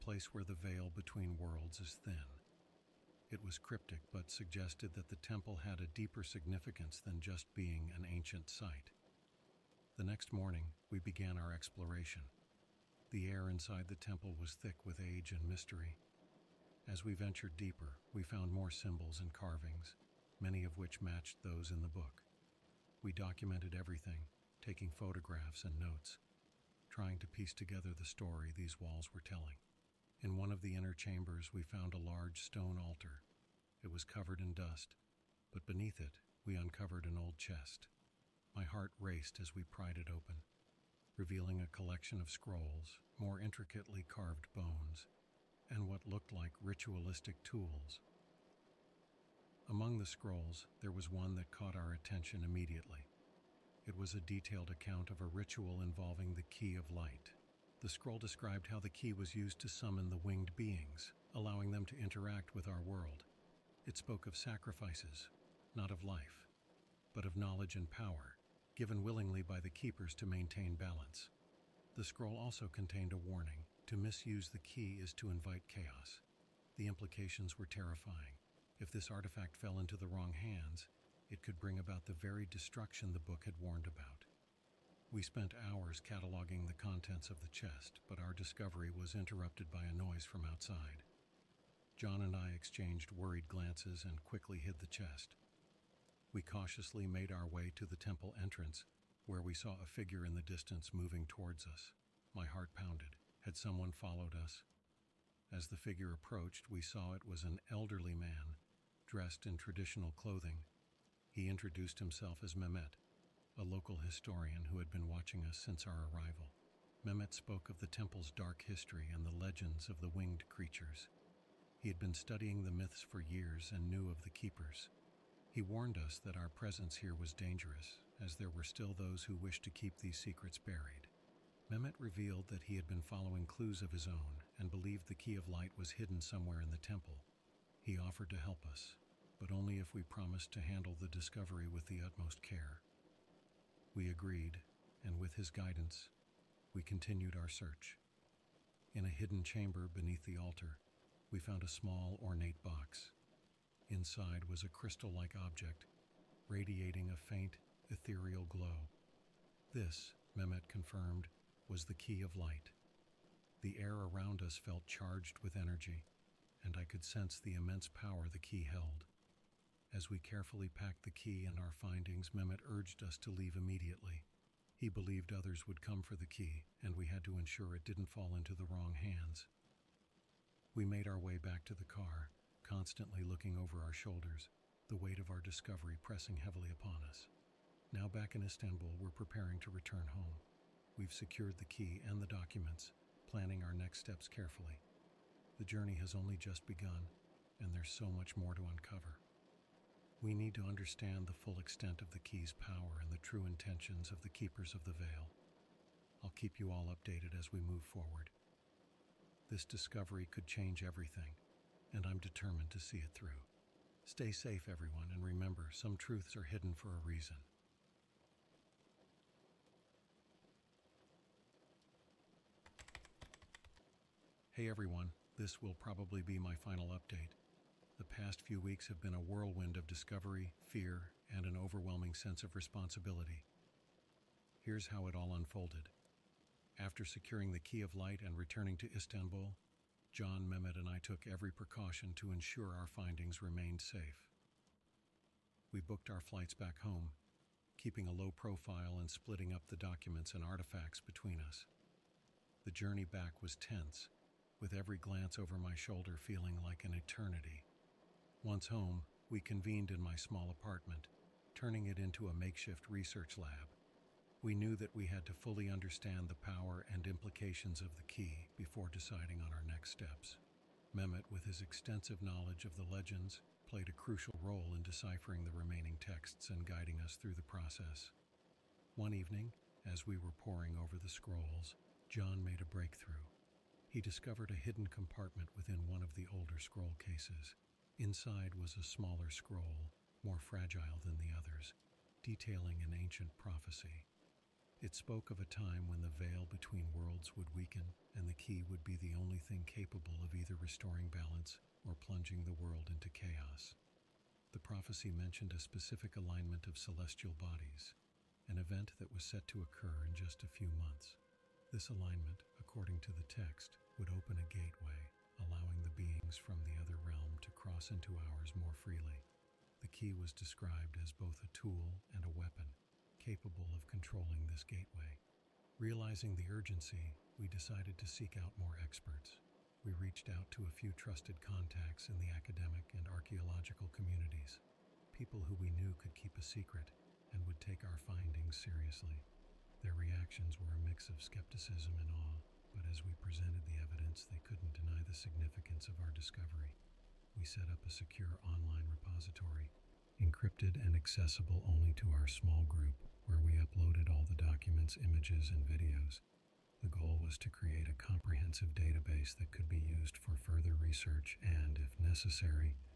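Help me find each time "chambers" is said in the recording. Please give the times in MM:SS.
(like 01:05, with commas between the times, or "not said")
00:30, 02:29.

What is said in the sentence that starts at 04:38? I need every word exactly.
One evening, as we were poring over the scrolls, John made a breakthrough.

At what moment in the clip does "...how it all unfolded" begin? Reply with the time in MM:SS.
03:54.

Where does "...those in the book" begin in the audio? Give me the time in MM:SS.
00:21.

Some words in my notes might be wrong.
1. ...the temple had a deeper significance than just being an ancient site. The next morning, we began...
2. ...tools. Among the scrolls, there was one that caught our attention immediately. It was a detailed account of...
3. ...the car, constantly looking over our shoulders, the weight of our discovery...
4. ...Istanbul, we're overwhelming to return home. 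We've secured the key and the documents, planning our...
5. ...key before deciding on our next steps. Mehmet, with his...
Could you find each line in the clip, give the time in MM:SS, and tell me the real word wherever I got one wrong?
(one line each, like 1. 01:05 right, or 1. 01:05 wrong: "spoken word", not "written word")
1. 00:05 right
2. 00:47 right
3. 03:01 right
4. 03:08 wrong: "preparing", not "overwhelming"
5. 04:28 right.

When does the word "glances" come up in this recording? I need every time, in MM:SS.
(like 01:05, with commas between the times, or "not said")
01:33, 04:14.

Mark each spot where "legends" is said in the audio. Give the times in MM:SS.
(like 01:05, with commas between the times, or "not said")
01:59, 04:32.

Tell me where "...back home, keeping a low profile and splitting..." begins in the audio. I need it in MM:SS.
04:06.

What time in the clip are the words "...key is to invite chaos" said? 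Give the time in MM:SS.
01:14.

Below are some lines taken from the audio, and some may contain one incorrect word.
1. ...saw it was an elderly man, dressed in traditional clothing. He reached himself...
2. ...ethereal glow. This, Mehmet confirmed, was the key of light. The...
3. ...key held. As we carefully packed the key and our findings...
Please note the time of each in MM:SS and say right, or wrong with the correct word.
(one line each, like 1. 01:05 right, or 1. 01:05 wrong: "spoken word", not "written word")
1. 01:46 wrong: "introduced", not "reached"
2. 02:37 right
3. 02:48 right.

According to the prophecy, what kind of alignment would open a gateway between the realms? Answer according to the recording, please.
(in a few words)
Celestial bodies.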